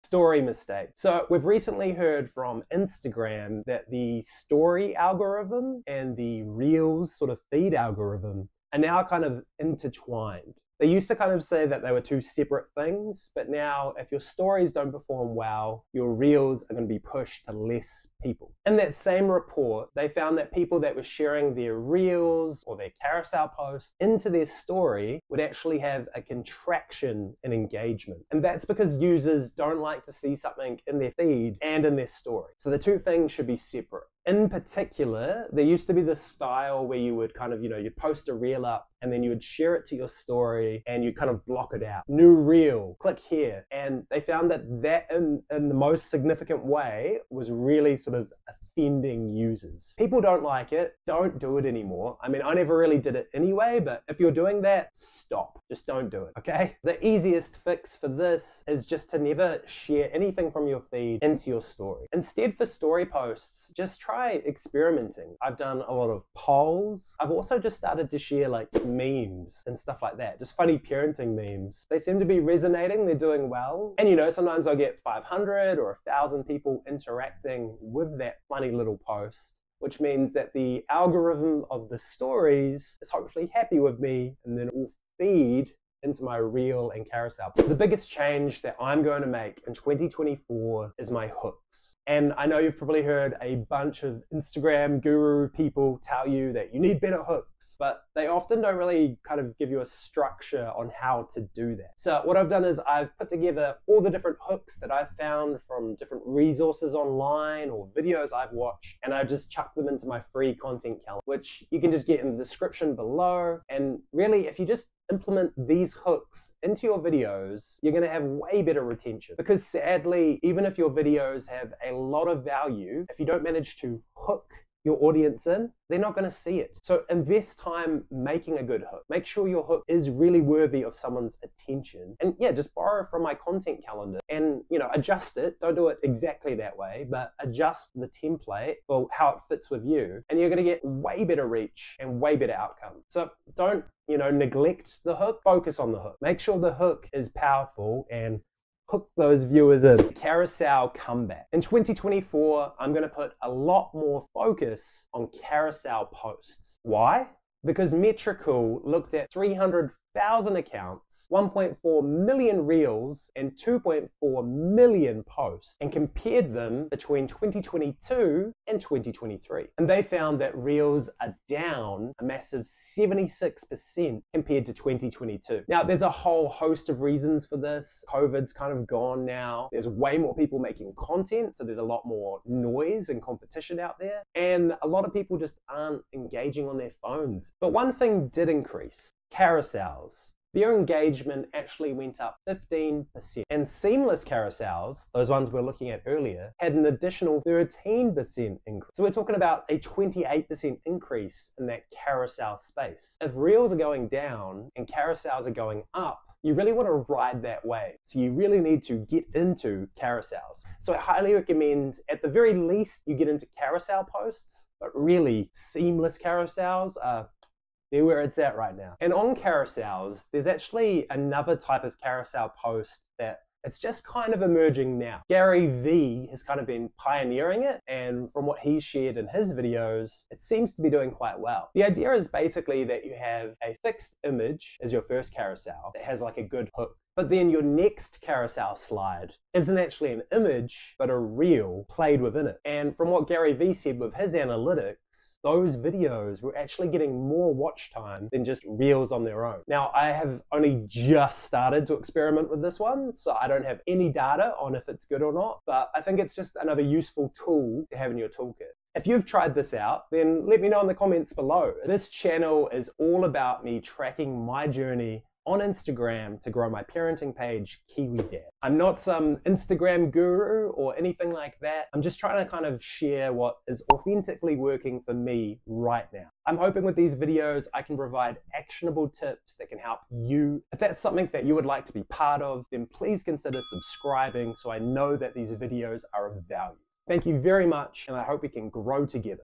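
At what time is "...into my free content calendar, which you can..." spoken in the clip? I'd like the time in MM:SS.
01:49.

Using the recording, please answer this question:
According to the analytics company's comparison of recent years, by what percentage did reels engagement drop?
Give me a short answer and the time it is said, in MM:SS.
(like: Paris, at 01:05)
76%, at 02:52.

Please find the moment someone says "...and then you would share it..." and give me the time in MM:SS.
00:39.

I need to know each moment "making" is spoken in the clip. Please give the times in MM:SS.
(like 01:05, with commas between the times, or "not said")
02:08, 03:00.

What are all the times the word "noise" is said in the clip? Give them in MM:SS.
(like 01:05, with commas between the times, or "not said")
03:02.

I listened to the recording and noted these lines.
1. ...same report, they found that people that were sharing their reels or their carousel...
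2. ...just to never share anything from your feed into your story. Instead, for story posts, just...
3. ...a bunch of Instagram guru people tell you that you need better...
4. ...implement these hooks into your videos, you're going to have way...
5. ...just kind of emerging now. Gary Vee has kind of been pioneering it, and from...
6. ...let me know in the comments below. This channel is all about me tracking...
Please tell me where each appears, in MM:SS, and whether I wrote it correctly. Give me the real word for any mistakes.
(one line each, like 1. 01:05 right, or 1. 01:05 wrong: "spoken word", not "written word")
1. 00:18 right
2. 00:58 right
3. 01:33 right
4. 01:55 right
5. 03:43 right
6. 04:20 right.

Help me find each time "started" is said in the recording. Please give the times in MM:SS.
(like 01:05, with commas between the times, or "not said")
01:07, 04:11.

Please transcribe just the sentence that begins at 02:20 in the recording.
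And you're going to get way better reach and way better outcome.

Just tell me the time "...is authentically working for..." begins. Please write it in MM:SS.
04:33.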